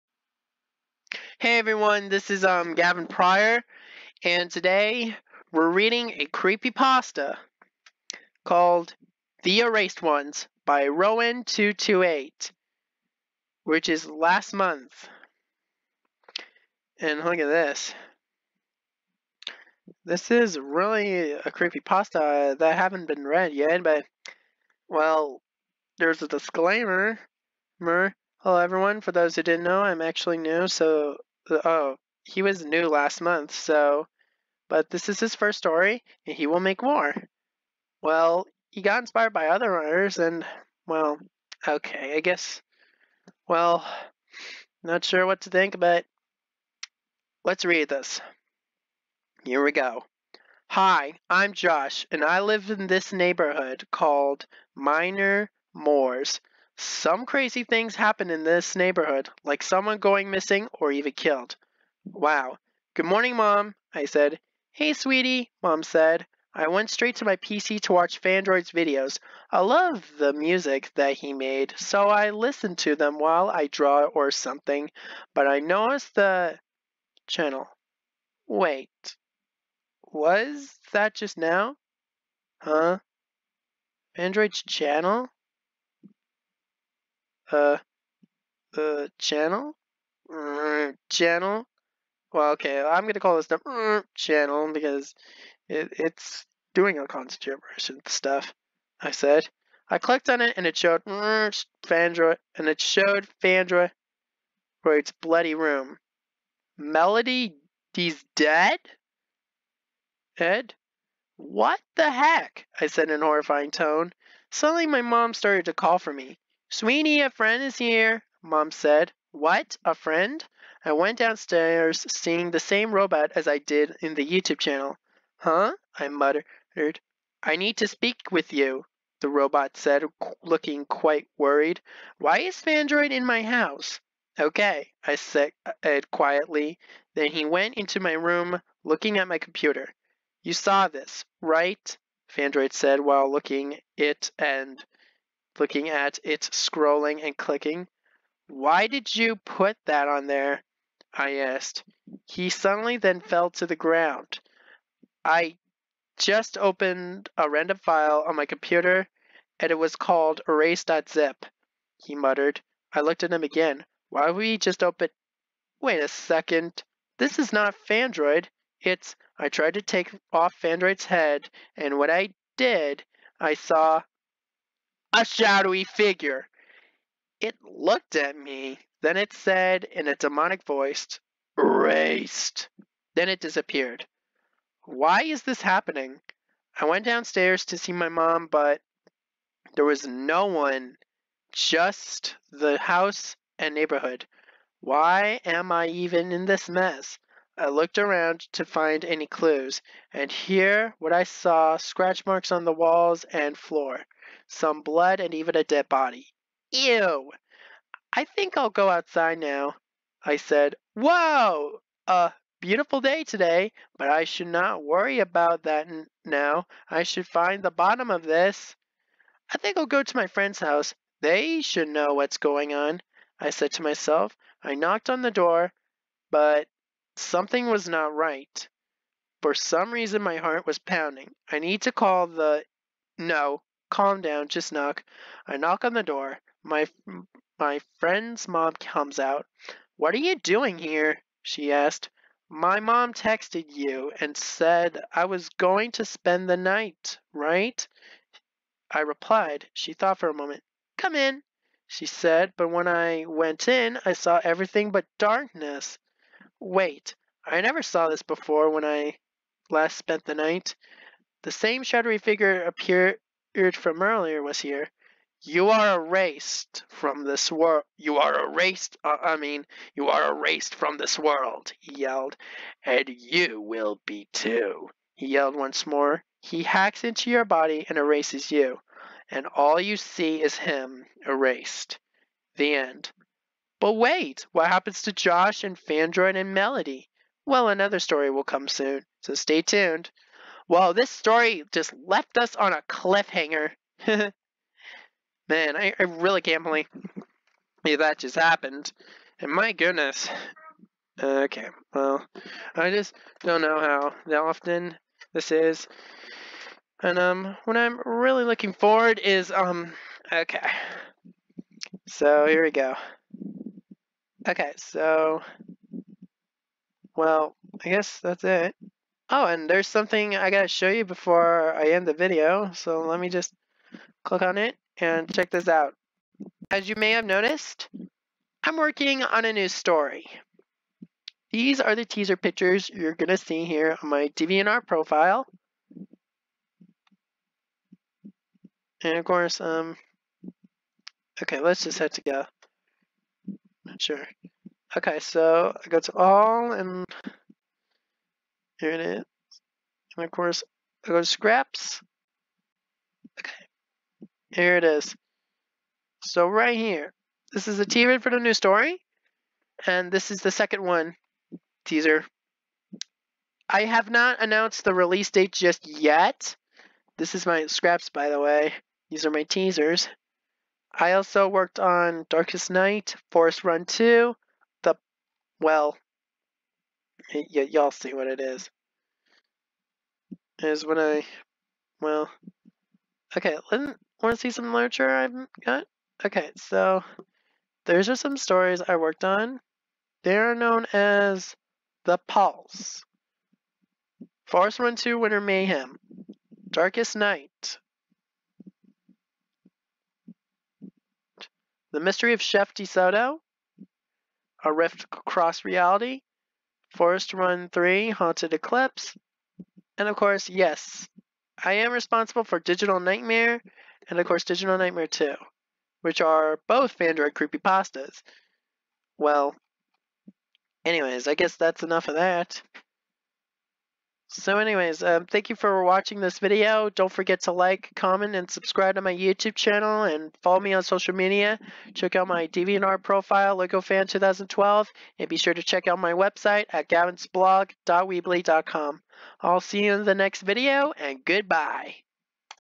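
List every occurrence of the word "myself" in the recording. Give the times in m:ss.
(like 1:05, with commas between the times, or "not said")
3:43.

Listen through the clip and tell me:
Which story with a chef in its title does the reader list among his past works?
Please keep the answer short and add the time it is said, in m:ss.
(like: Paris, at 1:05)
The Mystery of Chef DeSoto, at 6:41.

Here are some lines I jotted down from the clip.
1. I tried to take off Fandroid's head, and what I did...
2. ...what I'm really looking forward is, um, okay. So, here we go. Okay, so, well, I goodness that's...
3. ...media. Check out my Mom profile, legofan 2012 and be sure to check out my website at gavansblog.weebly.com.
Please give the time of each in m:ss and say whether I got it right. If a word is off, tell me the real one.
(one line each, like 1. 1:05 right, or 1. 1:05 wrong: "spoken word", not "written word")
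1. 2:49 right
2. 5:07 wrong: "guess", not "goodness"
3. 7:11 wrong: "DeviantArt", not "Mom".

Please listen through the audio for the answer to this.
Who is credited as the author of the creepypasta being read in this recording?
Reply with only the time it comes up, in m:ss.
0:10.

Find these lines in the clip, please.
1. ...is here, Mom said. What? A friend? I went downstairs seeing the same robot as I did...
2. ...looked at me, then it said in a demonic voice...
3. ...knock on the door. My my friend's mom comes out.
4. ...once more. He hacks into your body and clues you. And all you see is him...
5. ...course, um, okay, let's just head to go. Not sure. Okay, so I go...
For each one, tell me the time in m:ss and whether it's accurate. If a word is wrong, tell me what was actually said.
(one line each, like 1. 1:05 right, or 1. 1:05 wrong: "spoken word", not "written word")
1. 1:57 right
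2. 2:57 right
3. 3:55 right
4. 4:35 wrong: "erases", not "clues"
5. 5:39 right.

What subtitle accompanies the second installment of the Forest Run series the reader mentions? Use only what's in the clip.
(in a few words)
Winter Mayhem.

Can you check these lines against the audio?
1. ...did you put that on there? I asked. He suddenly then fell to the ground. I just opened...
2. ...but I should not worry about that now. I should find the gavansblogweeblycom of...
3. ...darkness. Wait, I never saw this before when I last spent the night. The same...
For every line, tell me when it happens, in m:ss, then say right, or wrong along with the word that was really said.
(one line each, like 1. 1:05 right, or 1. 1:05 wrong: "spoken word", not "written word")
1. 2:28 right
2. 3:33 wrong: "bottom", not "gavansblogweeblycom"
3. 4:15 right.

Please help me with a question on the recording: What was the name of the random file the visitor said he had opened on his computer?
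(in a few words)
erase.zip.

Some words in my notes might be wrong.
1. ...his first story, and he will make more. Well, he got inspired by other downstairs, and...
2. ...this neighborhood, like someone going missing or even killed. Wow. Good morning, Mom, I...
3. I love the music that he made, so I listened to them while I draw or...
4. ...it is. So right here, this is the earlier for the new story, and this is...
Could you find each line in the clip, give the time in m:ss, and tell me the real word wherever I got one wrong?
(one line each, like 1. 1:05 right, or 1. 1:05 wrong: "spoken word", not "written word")
1. 0:35 wrong: "runners", not "downstairs"
2. 0:58 right
3. 1:09 right
4. 5:54 wrong: "teaser", not "earlier".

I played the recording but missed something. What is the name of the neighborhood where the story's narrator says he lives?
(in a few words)
Minor Moors.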